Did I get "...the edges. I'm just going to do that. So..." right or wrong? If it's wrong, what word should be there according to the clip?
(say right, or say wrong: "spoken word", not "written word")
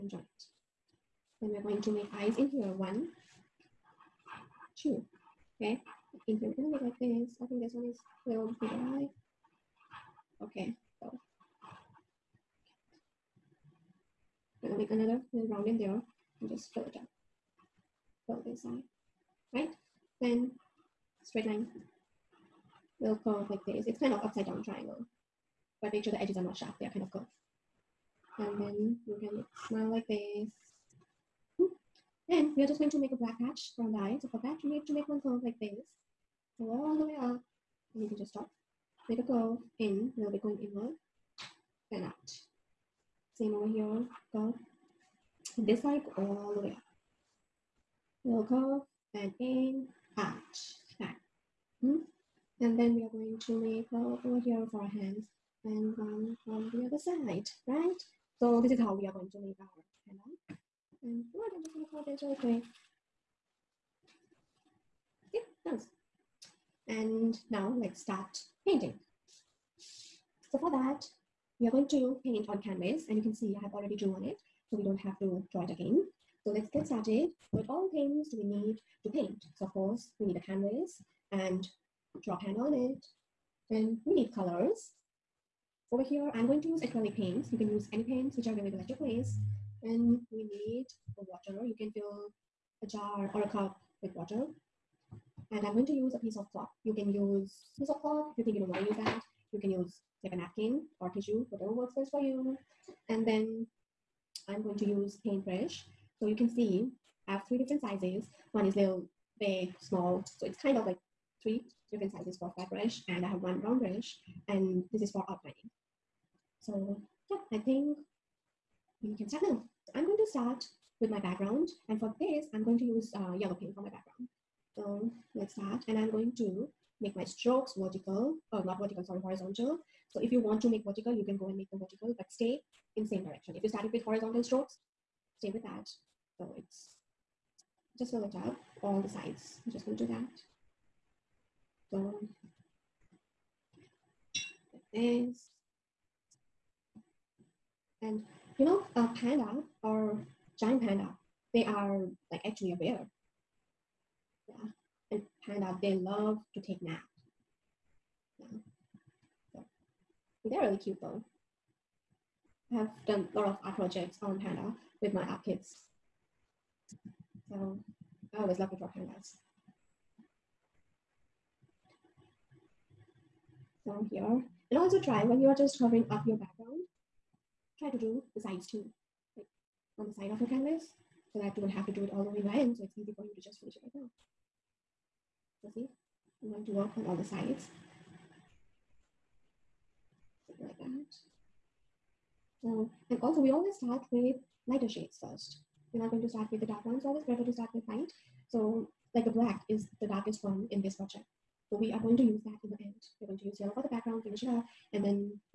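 wrong: "sides", not "edges".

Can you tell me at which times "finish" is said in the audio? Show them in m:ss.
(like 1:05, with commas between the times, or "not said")
3:03, 3:24.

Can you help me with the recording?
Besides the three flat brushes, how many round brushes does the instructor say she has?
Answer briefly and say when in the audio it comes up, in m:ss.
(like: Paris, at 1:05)
1, at 1:53.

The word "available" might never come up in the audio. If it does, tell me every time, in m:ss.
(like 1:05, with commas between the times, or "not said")
1:28.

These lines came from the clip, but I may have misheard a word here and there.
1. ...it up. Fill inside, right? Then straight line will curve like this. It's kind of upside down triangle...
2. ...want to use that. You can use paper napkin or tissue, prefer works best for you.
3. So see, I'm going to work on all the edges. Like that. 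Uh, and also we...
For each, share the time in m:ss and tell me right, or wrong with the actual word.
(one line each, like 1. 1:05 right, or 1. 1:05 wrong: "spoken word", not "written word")
1. 0:16 right
2. 1:38 wrong: "whatever", not "prefer"
3. 3:05 wrong: "sides", not "edges".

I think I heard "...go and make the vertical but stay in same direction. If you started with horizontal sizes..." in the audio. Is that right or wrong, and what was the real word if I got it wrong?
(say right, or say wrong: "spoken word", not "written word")
wrong: "strokes", not "sizes".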